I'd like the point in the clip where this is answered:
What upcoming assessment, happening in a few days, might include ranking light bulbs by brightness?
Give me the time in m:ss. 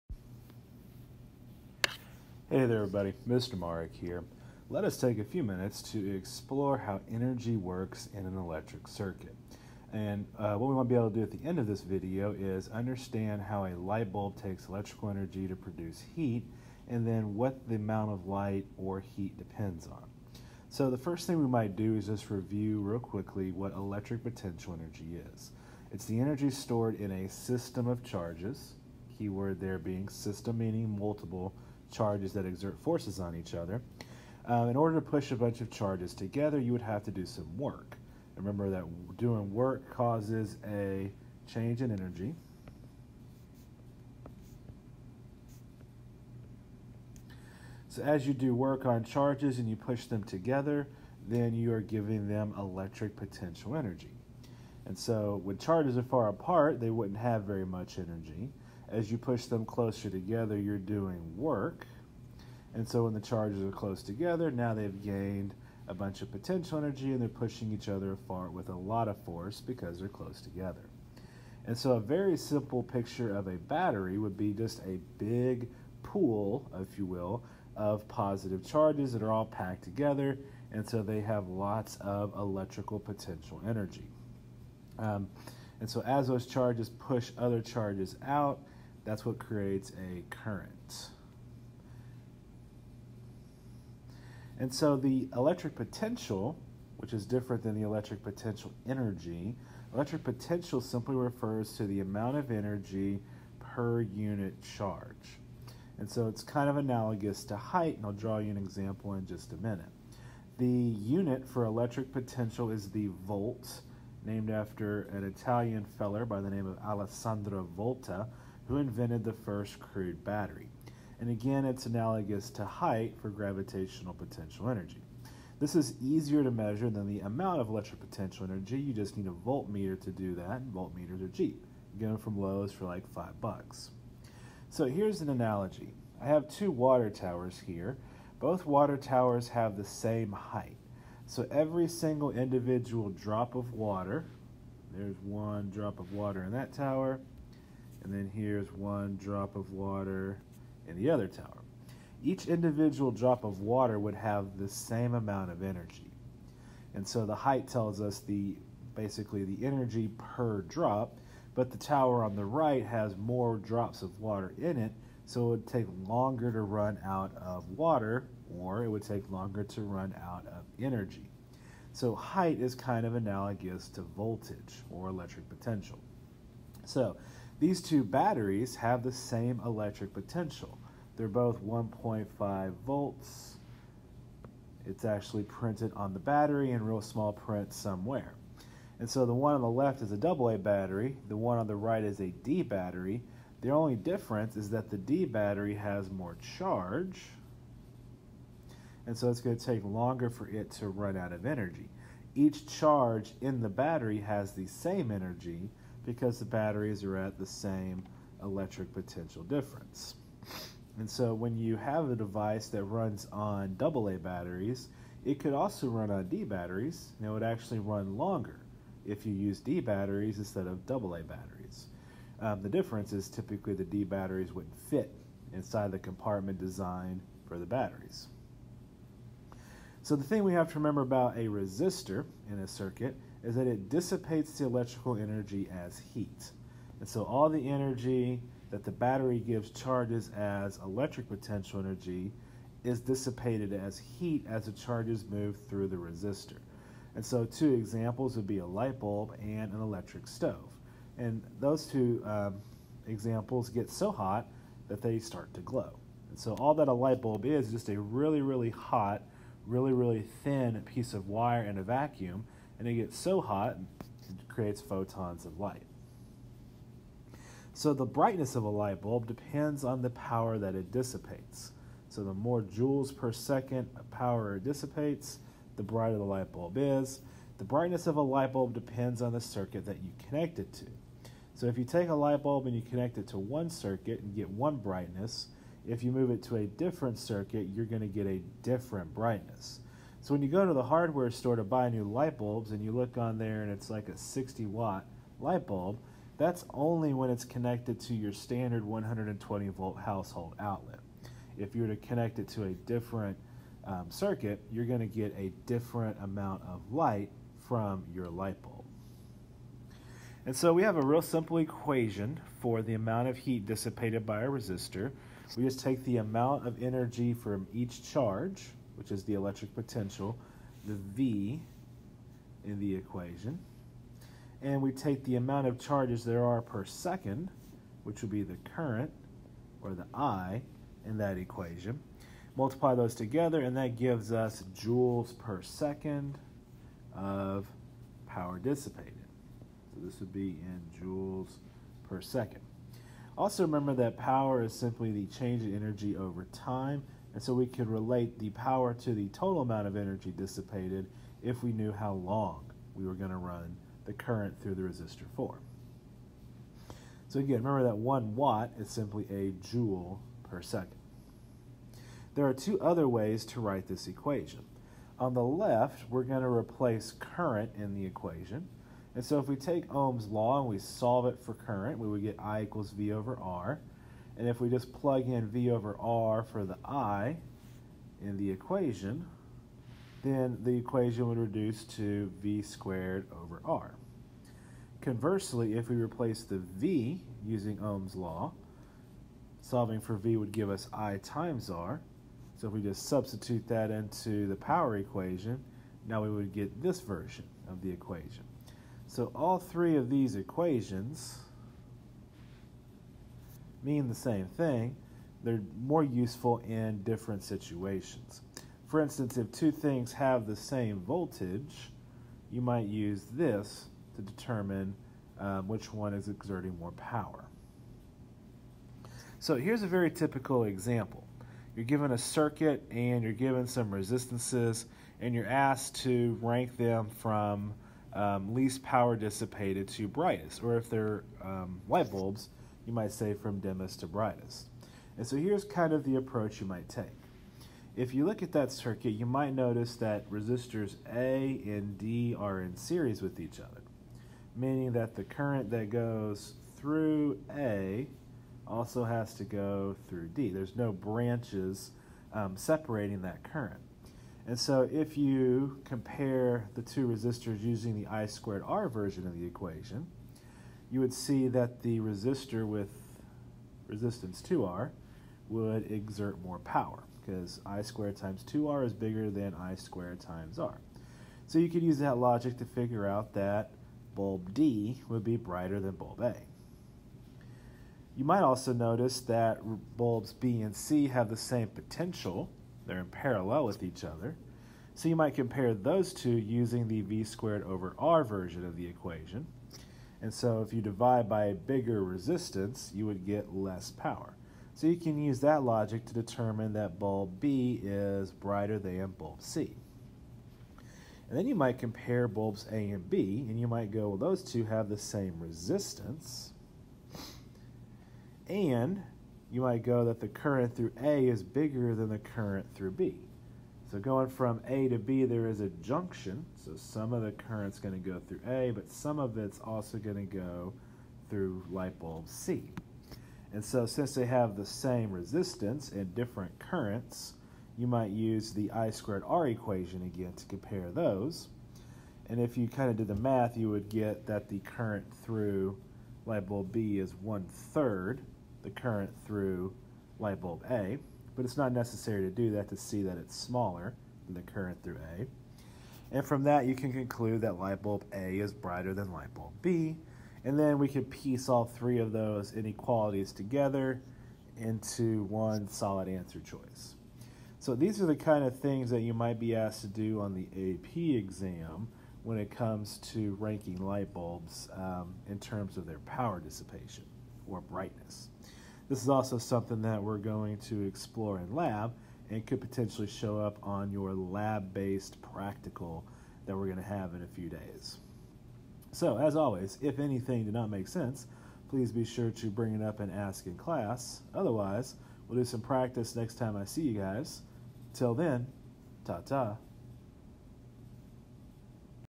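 9:34.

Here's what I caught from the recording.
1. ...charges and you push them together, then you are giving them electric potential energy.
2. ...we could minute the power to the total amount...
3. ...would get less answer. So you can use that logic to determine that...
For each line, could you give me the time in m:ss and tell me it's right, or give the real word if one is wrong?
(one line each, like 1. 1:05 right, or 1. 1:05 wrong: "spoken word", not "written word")
1. 0:49 right
2. 5:47 wrong: "relate", not "minute"
3. 8:13 wrong: "power", not "answer".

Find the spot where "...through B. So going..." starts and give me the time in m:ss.
8:32.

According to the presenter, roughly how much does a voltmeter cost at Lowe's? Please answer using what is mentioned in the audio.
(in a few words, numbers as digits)
5 bucks.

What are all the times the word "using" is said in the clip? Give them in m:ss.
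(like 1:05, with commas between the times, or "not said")
6:27, 7:37, 8:06.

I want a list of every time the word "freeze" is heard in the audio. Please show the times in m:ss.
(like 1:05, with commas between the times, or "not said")
not said.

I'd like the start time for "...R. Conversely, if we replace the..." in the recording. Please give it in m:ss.
6:23.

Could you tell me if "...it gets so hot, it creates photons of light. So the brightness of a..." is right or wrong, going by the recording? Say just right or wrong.
right.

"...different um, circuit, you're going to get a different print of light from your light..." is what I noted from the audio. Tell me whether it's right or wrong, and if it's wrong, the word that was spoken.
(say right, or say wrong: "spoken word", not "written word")
wrong: "amount", not "print".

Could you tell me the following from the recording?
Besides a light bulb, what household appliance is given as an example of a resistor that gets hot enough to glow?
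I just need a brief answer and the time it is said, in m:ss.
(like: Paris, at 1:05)
electric stove, at 4:09.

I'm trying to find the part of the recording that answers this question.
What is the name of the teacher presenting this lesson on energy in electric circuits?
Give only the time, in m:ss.
0:03.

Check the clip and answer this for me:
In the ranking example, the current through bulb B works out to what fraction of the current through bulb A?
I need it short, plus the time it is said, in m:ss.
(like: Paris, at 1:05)
1/3, at 8:57.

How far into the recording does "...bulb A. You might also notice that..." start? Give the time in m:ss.
7:55.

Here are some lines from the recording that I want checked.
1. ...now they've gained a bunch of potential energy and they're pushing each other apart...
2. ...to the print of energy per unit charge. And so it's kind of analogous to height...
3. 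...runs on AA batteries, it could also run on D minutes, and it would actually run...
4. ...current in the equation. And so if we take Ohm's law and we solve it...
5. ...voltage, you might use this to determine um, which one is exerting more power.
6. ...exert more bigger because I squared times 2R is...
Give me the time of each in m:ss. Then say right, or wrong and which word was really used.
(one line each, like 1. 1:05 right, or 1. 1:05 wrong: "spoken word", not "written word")
1. 1:04 right
2. 1:41 wrong: "amount", not "print"
3. 3:32 wrong: "batteries", not "minutes"
4. 6:07 right
5. 6:50 right
6. 7:45 wrong: "power", not "bigger".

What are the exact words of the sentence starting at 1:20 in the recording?
And so they have lots of electrical potential energy.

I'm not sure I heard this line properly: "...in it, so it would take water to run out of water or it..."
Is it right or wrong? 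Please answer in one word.
wrong.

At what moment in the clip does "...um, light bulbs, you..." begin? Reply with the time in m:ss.
7:11.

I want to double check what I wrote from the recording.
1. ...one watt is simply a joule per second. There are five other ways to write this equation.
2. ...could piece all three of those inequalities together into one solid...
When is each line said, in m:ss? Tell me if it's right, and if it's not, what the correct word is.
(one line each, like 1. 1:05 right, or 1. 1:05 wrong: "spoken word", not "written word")
1. 5:57 wrong: "two", not "five"
2. 9:10 right.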